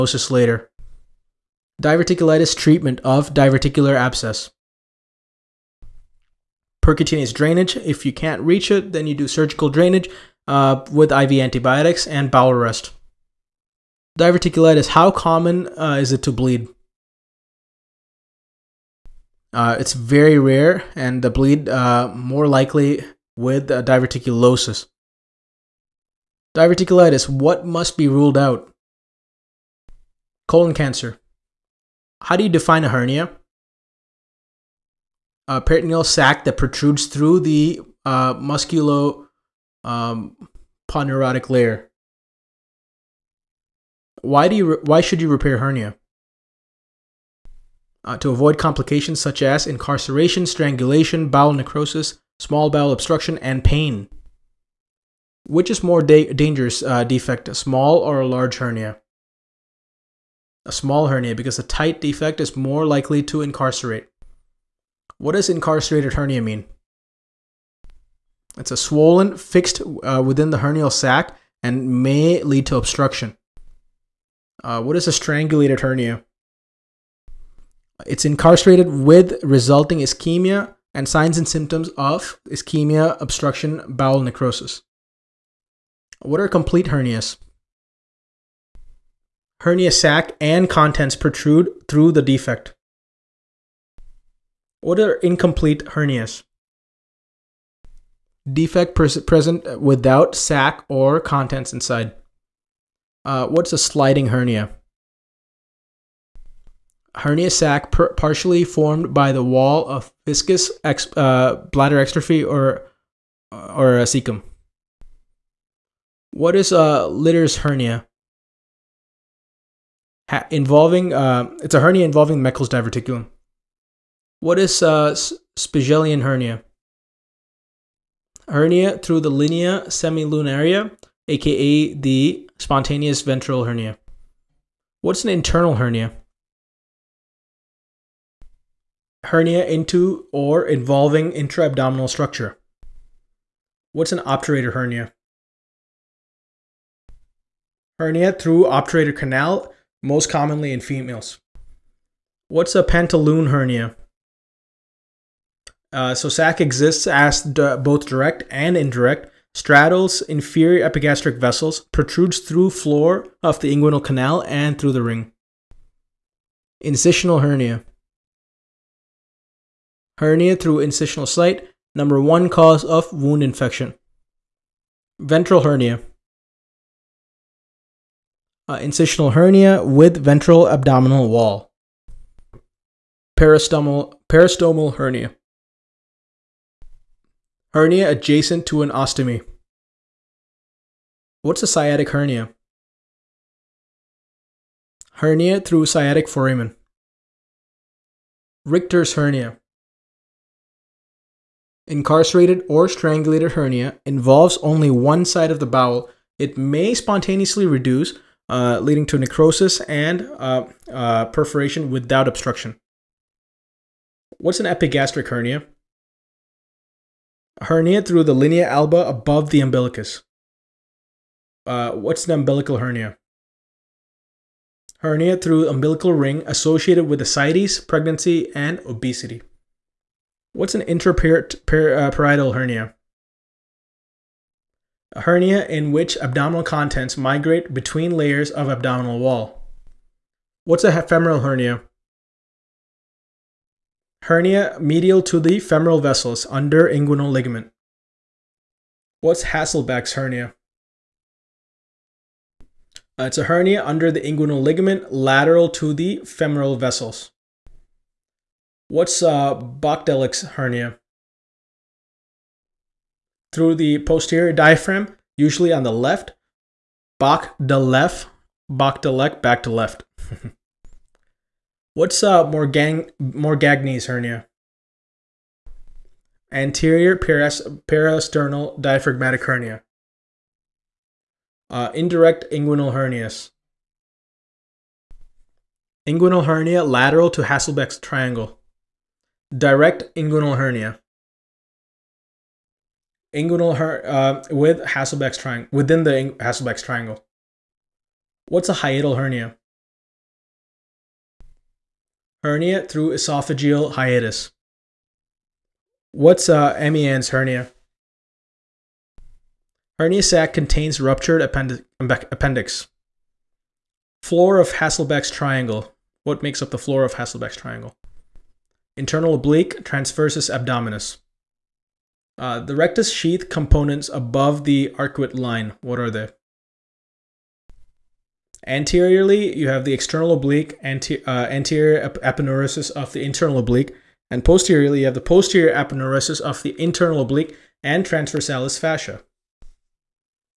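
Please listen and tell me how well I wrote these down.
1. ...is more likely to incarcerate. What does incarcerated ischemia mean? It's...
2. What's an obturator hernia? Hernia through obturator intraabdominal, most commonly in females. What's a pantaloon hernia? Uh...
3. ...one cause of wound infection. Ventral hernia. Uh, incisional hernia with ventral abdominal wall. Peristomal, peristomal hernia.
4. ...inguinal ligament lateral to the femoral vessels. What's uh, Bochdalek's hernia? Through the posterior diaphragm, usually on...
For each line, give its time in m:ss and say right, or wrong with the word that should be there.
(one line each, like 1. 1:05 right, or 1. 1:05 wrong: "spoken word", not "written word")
1. 1:02 wrong: "hernia", not "ischemia"
2. 2:23 wrong: "canal", not "intraabdominal"
3. 2:52 right
4. 4:14 right.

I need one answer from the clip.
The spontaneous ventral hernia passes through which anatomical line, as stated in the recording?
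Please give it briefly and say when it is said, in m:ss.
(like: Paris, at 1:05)
Linea semilunaria, at 2:09.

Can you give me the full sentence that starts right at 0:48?
Uh, to avoid complications such as incarceration, strangulation, bowel necrosis, small bowel obstruction, and pain.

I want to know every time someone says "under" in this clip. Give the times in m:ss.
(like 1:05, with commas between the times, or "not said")
4:06, 4:13.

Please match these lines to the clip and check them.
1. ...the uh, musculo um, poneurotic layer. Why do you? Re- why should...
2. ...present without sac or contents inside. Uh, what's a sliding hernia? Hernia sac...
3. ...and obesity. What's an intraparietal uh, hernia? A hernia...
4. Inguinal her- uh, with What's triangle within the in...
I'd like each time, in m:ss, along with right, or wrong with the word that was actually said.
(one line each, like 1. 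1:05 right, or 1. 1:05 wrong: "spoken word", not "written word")
1. 0:37 right
2. 1:38 right
3. 3:48 right
4. 4:53 wrong: "Hesselbach", not "What".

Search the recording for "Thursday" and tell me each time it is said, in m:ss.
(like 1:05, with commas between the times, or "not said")
not said.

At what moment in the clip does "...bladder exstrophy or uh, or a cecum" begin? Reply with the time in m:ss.
1:51.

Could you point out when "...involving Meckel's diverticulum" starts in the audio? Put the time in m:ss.
2:02.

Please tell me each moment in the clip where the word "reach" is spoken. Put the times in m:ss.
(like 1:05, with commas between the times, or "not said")
0:08.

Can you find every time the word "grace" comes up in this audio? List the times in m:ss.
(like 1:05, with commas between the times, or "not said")
not said.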